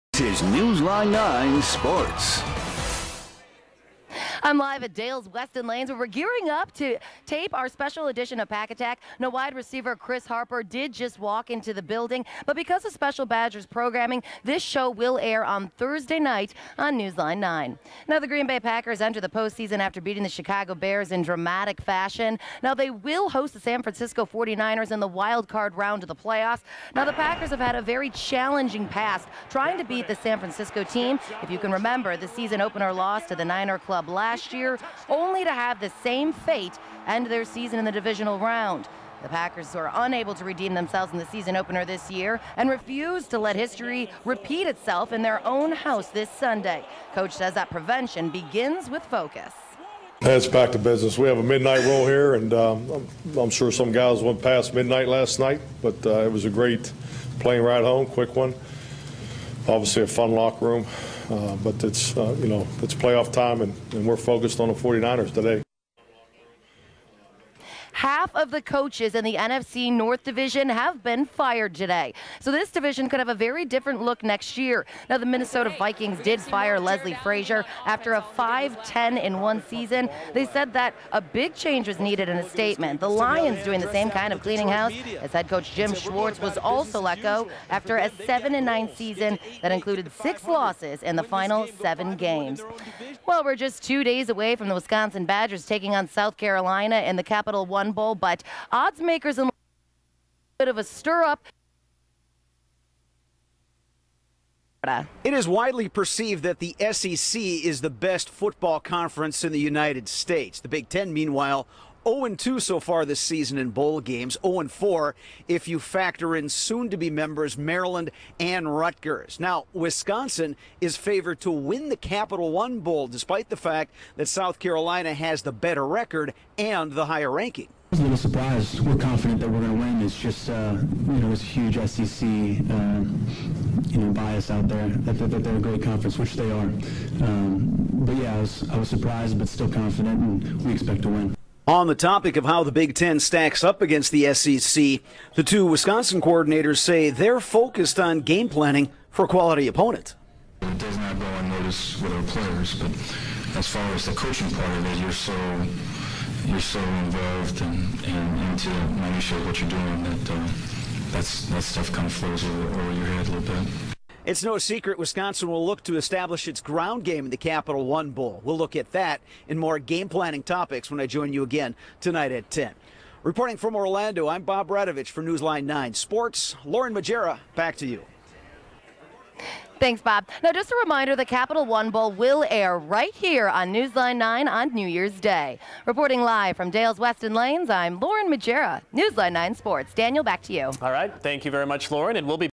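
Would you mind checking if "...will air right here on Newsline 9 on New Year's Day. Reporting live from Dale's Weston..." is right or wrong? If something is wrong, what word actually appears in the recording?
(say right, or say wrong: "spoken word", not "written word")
right.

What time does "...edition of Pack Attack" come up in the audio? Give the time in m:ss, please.
0:08.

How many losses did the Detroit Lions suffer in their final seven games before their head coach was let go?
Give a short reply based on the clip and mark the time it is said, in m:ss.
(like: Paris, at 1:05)
6, at 1:30.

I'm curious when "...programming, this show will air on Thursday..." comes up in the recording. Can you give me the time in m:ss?
0:13.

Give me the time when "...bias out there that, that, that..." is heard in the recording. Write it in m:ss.
2:14.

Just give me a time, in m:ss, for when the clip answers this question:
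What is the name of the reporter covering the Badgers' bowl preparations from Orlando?
2:54.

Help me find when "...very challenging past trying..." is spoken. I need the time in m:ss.
0:27.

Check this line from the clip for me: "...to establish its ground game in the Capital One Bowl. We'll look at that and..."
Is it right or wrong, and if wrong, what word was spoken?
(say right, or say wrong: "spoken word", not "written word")
right.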